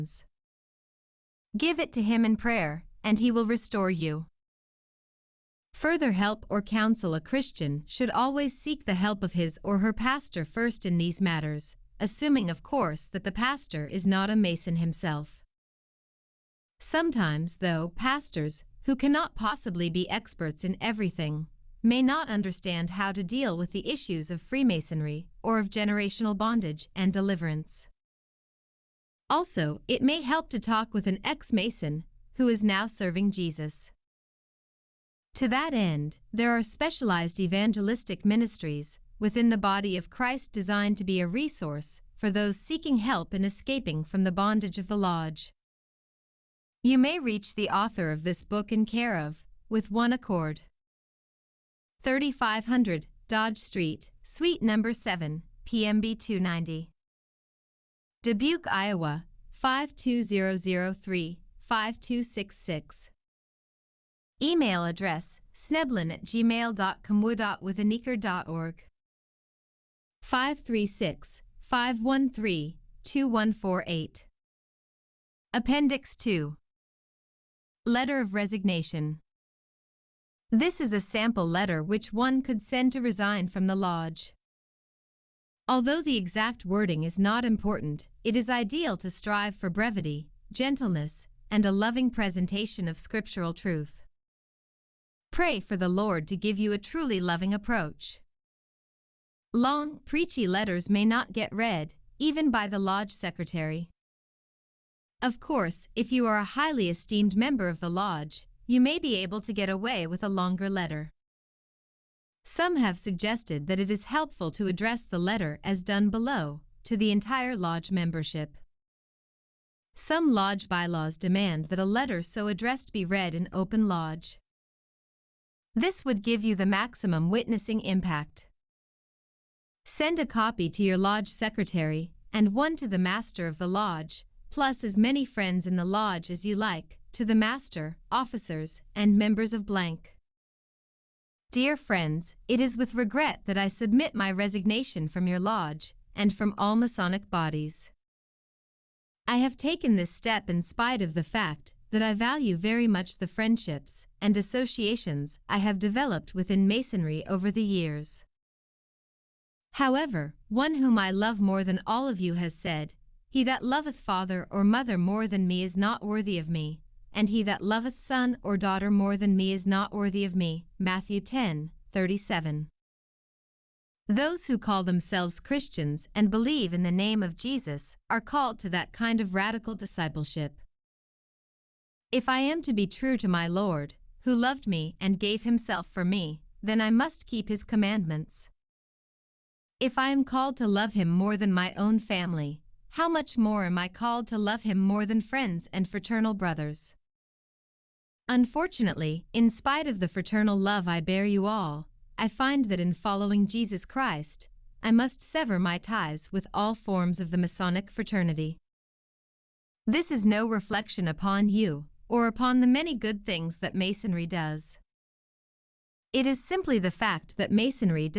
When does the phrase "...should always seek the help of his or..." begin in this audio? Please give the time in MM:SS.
00:07.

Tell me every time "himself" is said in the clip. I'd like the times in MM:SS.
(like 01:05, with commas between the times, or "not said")
00:14, 03:05.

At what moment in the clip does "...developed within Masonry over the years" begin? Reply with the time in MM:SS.
02:35.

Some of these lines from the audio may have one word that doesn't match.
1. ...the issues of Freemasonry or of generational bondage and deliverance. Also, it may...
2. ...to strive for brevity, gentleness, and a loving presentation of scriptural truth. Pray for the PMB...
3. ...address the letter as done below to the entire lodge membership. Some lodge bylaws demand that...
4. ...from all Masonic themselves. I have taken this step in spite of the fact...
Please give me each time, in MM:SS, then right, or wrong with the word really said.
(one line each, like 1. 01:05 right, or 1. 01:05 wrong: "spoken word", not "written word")
1. 00:23 right
2. 01:28 wrong: "Lord", not "PMB"
3. 01:54 right
4. 02:26 wrong: "bodies", not "themselves".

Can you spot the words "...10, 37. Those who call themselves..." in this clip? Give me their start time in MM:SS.
02:51.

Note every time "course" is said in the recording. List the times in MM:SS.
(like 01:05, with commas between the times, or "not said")
00:12, 01:45.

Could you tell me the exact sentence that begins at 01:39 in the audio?
Long, preachy letters may not get read, even by the lodge secretary.